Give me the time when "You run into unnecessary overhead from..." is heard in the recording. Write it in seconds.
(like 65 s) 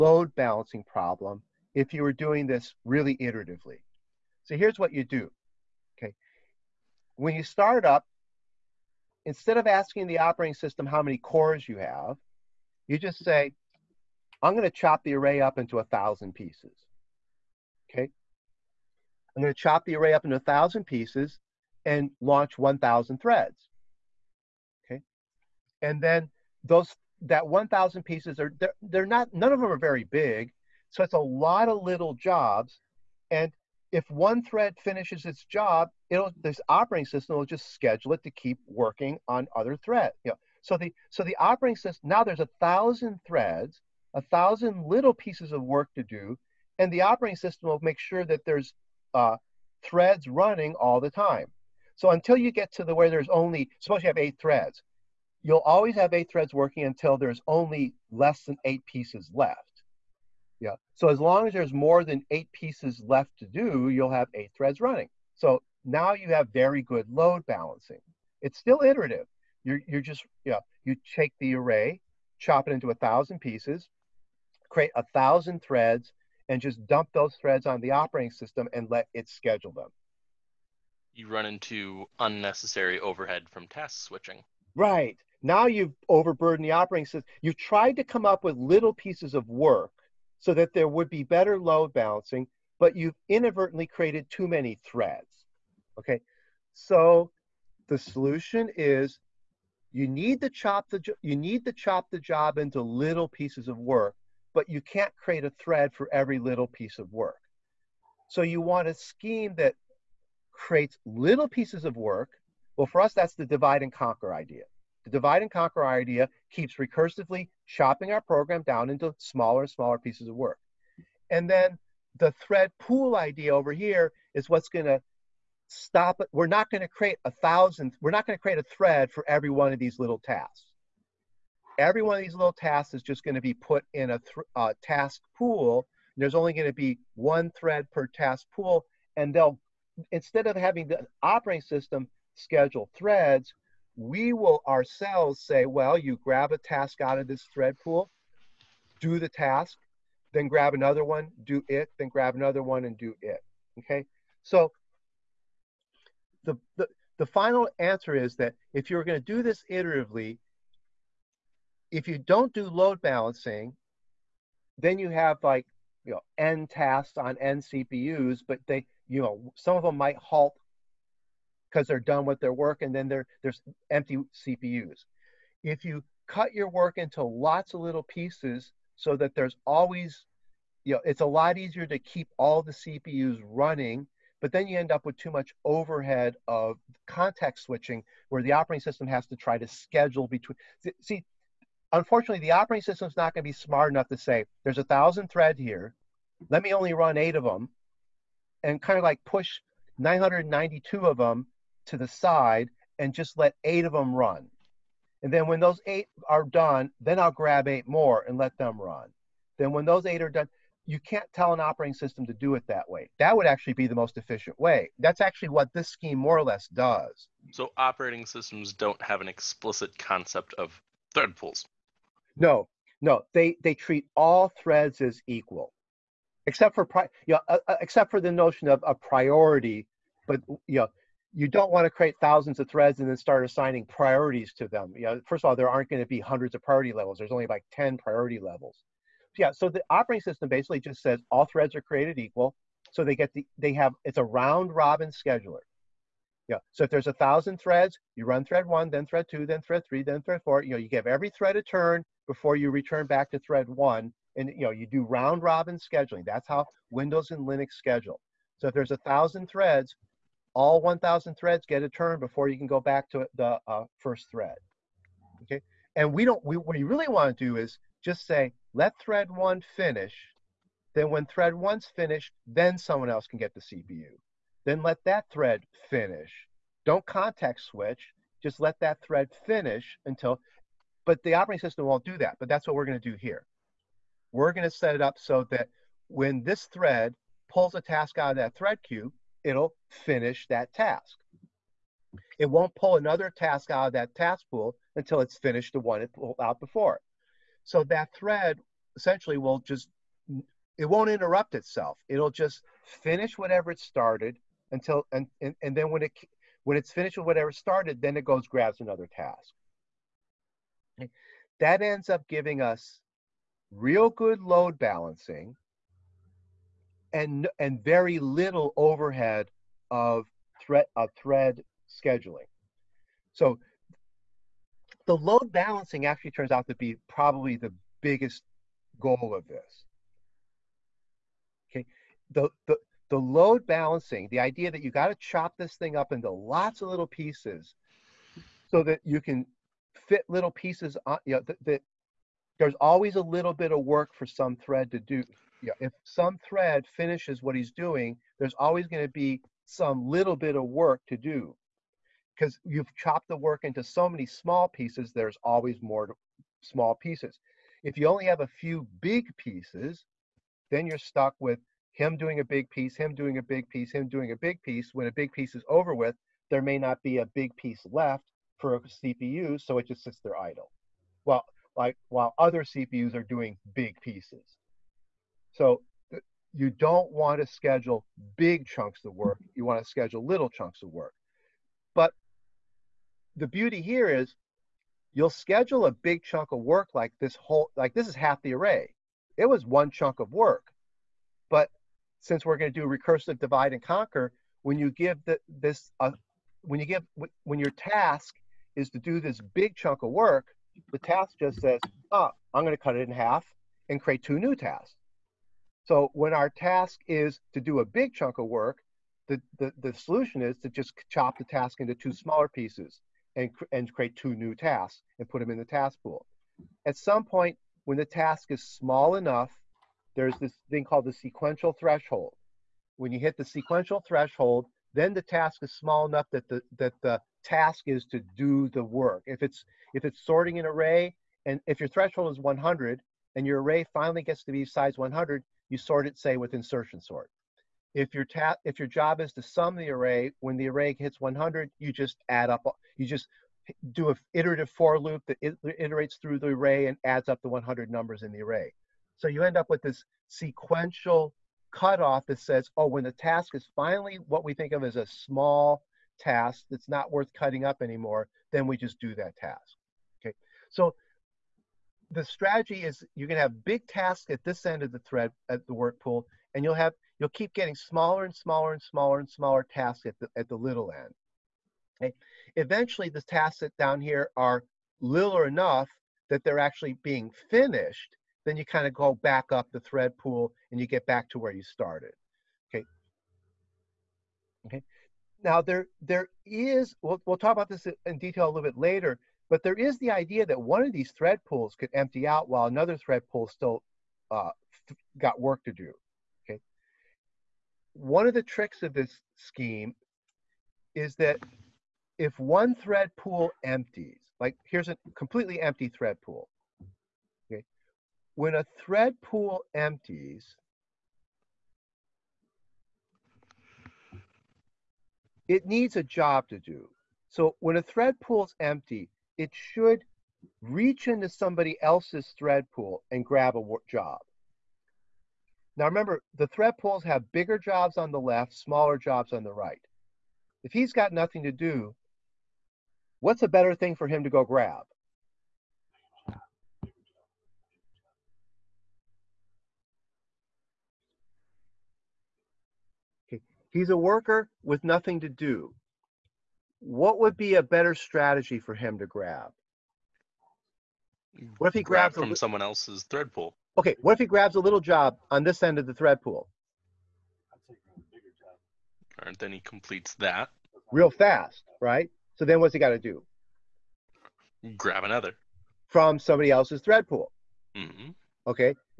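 81 s.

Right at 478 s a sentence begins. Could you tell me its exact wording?
Then you kind of go back up the thread pool and you get back to where you started.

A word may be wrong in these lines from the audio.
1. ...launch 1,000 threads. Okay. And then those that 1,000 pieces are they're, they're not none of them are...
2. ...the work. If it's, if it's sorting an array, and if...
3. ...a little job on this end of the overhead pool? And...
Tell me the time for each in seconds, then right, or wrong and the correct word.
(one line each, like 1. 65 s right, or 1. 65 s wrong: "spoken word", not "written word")
1. 22 s right
2. 428 s right
3. 554 s wrong: "thread", not "overhead".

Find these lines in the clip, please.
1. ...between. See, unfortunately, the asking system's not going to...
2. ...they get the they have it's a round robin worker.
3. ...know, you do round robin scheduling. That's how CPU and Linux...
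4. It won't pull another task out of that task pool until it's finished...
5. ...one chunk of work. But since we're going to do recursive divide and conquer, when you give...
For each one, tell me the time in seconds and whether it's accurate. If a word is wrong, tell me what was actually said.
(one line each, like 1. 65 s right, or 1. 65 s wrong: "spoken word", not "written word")
1. 190 s wrong: "operating", not "asking"
2. 243 s wrong: "scheduler", not "worker"
3. 254 s wrong: "Windows", not "CPU"
4. 292 s right
5. 389 s right.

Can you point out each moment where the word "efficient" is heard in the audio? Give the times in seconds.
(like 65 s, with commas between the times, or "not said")
214 s.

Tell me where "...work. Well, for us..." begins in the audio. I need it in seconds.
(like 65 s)
111 s.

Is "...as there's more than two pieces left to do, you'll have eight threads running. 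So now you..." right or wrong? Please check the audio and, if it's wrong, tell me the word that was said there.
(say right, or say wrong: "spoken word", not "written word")
wrong: "eight", not "two".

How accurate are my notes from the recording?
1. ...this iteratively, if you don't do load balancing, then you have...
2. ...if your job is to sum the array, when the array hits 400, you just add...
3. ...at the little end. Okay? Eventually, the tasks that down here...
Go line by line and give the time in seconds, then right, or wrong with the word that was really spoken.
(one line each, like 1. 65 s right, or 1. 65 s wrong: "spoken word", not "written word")
1. 159 s right
2. 438 s wrong: "100", not "400"
3. 470 s right.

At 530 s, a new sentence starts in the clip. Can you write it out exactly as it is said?
If he's got nothing to do, what's a better thing for him to go grab?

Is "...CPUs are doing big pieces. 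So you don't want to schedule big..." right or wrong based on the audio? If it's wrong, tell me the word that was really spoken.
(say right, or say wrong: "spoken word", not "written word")
right.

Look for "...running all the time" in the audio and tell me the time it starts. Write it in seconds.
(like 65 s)
50 s.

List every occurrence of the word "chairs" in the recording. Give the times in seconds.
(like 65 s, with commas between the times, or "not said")
not said.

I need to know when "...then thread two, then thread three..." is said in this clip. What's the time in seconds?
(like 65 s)
248 s.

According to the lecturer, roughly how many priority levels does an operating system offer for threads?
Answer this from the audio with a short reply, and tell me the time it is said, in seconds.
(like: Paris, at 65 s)
10, at 237 s.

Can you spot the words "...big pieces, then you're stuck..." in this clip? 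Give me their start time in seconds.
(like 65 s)
358 s.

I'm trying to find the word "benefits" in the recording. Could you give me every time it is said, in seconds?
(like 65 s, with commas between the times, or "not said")
not said.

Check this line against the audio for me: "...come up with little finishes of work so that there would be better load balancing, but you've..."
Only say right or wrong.
wrong.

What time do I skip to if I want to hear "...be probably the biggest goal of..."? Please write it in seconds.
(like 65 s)
326 s.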